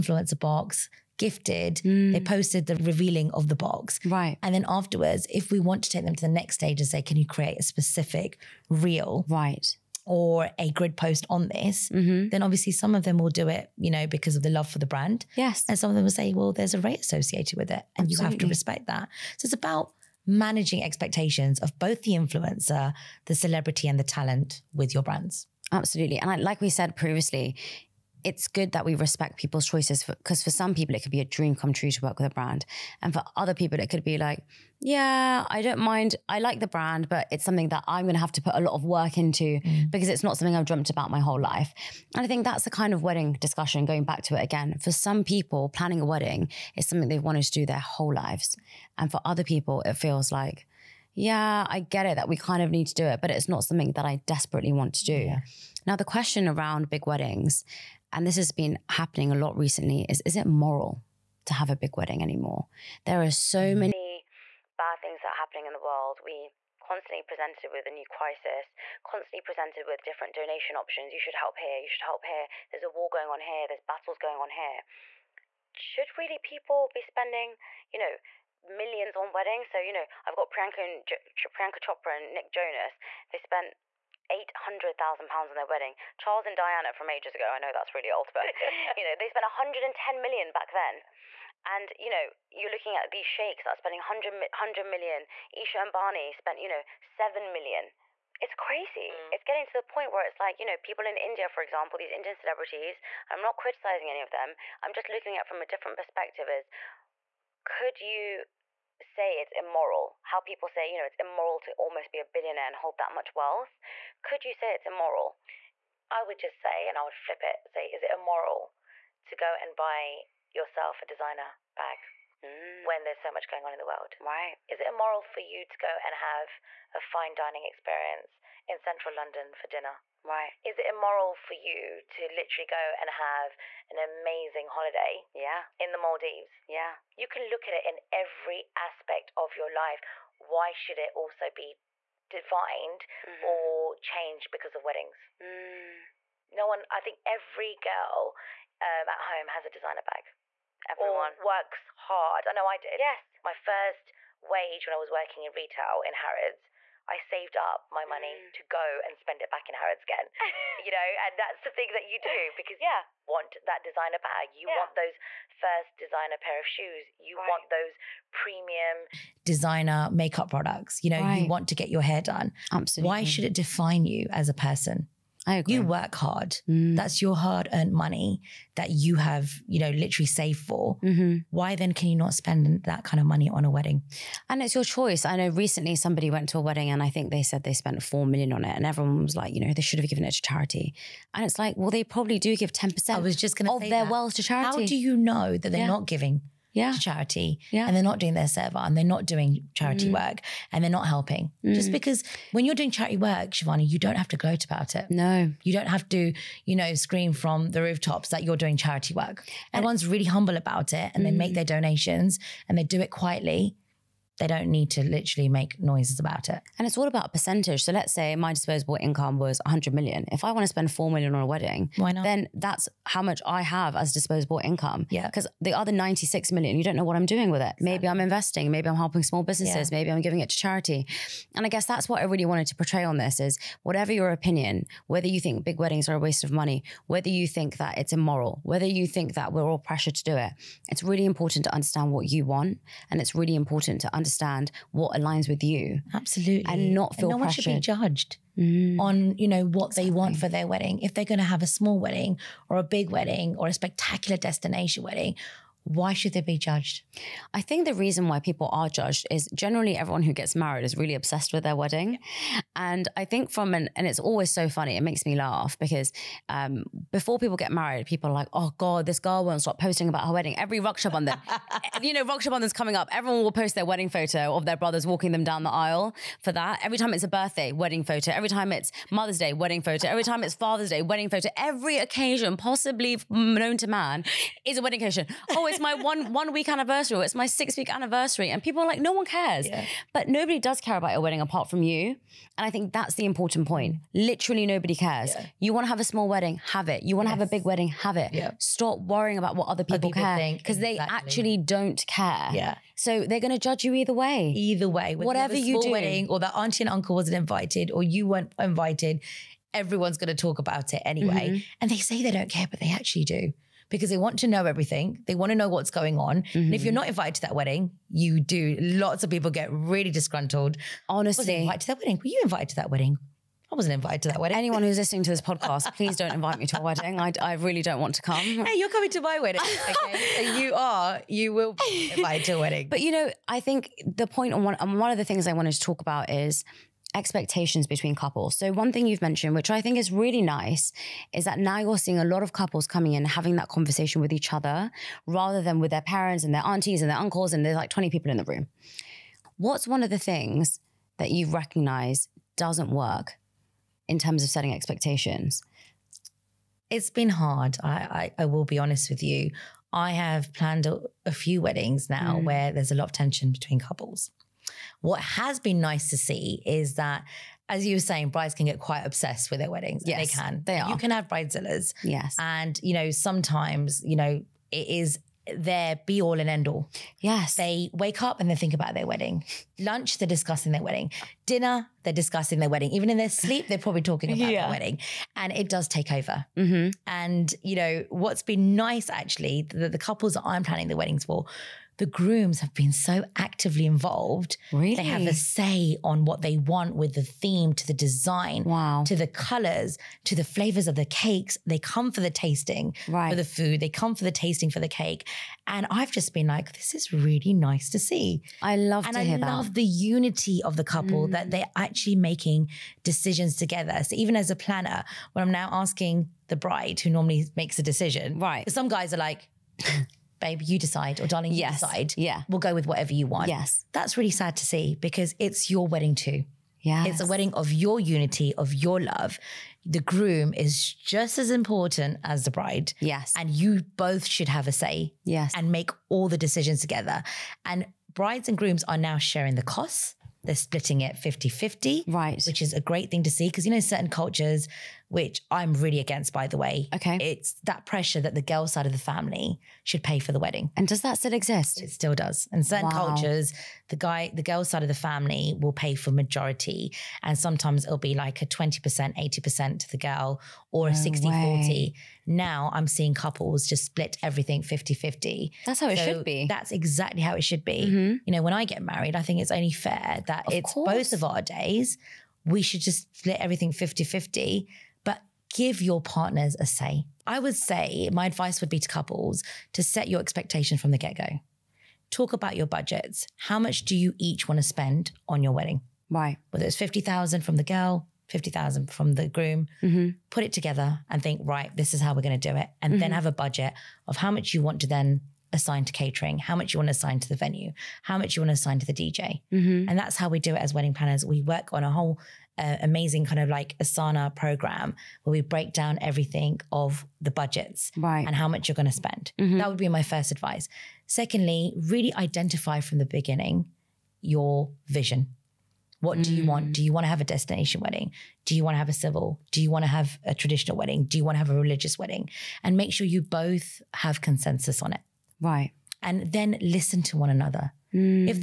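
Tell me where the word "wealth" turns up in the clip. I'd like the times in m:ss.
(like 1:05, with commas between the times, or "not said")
1:53, 3:14.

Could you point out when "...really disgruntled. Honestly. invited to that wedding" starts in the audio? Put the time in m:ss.
5:19.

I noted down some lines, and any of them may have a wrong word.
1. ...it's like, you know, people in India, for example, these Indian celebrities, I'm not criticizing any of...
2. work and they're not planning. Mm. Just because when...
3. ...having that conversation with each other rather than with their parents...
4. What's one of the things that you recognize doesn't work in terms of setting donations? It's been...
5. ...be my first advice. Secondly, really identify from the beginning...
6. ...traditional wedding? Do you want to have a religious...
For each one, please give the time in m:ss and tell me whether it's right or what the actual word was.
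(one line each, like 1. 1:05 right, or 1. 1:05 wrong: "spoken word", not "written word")
1. 1:40 right
2. 3:20 wrong: "helping", not "planning"
3. 5:43 right
4. 5:49 wrong: "expectations", not "donations"
5. 8:29 right
6. 8:40 right.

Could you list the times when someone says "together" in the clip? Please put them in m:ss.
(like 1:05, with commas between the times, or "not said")
6:53, 7:16, 8:10.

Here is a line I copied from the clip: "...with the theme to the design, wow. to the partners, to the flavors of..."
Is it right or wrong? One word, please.
wrong.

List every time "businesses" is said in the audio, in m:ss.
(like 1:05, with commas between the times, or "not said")
3:49.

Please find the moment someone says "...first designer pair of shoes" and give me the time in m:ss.
2:45.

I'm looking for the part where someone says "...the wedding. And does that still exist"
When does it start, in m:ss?
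7:30.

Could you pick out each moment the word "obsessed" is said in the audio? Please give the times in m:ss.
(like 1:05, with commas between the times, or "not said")
4:21, 6:09.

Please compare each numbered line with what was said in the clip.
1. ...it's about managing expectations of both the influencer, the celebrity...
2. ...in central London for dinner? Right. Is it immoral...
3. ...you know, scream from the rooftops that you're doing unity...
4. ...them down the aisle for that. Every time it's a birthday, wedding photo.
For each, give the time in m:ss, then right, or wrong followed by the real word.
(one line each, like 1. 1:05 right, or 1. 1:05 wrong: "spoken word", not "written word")
1. 0:19 right
2. 2:08 right
3. 3:26 wrong: "charity", not "unity"
4. 4:35 right.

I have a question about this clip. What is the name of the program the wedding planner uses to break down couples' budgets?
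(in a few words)
Asana.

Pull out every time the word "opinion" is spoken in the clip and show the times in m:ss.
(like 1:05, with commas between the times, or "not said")
3:54.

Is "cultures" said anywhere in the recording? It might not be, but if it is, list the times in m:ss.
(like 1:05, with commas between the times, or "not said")
7:24, 7:33.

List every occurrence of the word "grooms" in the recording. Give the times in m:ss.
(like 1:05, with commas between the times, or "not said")
6:32, 7:10, 7:18, 8:09.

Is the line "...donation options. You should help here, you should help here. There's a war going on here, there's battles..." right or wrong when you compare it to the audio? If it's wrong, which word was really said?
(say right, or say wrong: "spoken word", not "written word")
right.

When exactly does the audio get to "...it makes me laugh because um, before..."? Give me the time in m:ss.
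4:24.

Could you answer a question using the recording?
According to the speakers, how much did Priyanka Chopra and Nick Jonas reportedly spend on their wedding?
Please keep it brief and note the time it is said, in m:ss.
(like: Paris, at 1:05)
£800,000, at 1:24.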